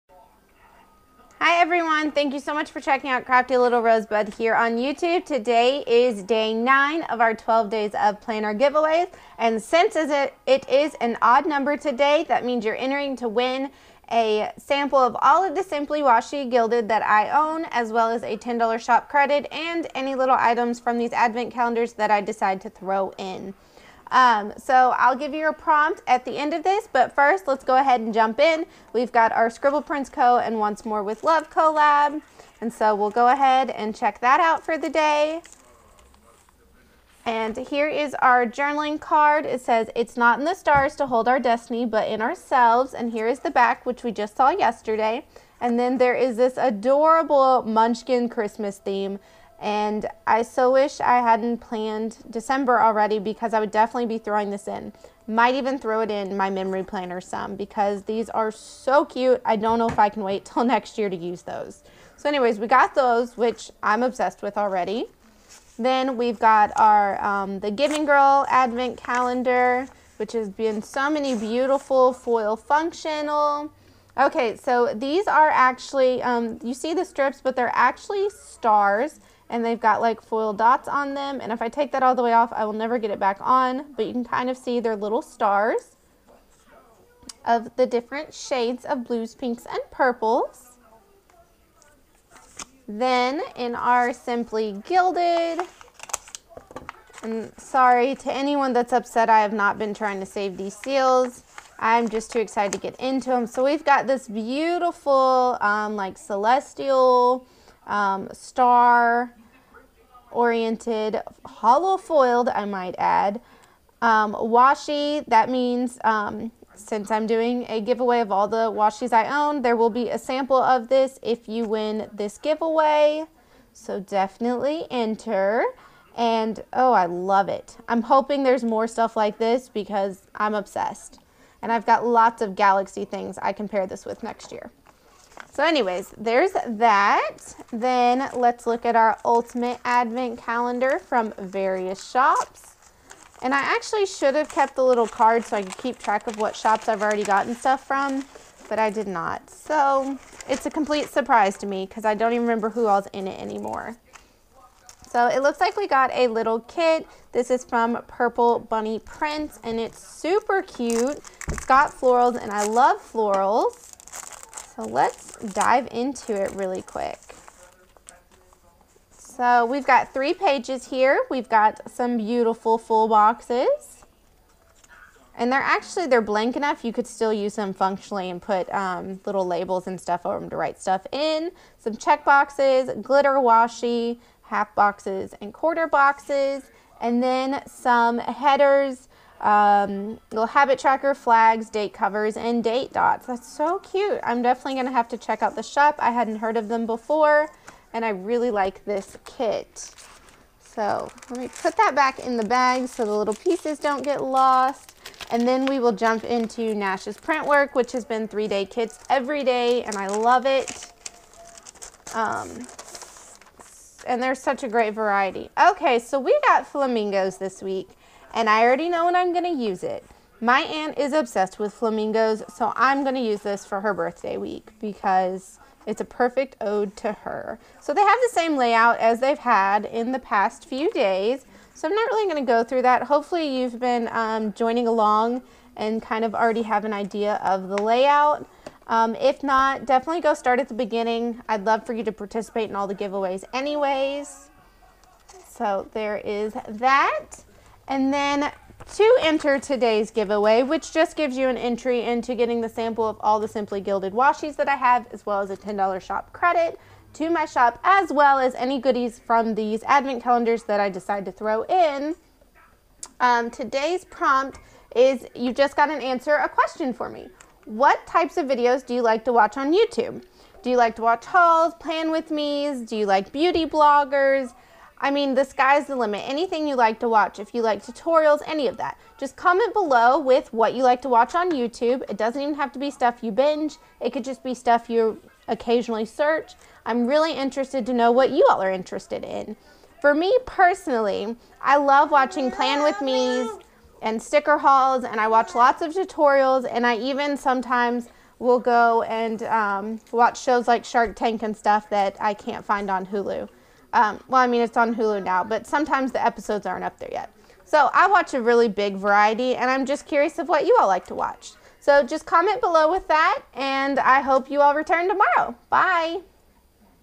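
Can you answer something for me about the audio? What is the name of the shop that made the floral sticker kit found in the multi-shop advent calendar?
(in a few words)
Purple Bunny Prints.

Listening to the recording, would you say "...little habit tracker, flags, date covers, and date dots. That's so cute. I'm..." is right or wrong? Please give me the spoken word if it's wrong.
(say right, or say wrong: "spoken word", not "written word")
right.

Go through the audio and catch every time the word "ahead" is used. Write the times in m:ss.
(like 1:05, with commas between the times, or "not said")
0:27, 0:33.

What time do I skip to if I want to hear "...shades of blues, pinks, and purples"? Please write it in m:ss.
1:28.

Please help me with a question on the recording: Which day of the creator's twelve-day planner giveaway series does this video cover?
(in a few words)
Day 9.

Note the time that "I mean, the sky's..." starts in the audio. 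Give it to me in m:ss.
4:35.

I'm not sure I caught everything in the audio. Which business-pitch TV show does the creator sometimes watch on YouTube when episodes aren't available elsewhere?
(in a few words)
Shark Tank.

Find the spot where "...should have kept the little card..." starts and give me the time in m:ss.
2:24.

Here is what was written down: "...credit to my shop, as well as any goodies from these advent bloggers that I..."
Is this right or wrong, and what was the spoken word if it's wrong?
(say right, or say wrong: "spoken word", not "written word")
wrong: "calendars", not "bloggers".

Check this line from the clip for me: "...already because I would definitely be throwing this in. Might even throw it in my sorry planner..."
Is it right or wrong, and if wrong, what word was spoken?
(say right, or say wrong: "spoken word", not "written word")
wrong: "memory", not "sorry".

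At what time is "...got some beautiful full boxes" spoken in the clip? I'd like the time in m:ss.
2:51.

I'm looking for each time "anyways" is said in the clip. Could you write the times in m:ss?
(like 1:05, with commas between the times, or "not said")
1:02, 2:15, 4:03.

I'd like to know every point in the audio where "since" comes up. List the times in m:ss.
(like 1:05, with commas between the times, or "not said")
0:09, 1:56.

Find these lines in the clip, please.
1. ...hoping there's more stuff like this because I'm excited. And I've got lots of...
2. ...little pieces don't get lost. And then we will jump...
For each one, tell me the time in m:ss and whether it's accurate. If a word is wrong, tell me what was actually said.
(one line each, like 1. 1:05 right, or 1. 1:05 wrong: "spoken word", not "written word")
1. 2:08 wrong: "obsessed", not "excited"
2. 3:23 right.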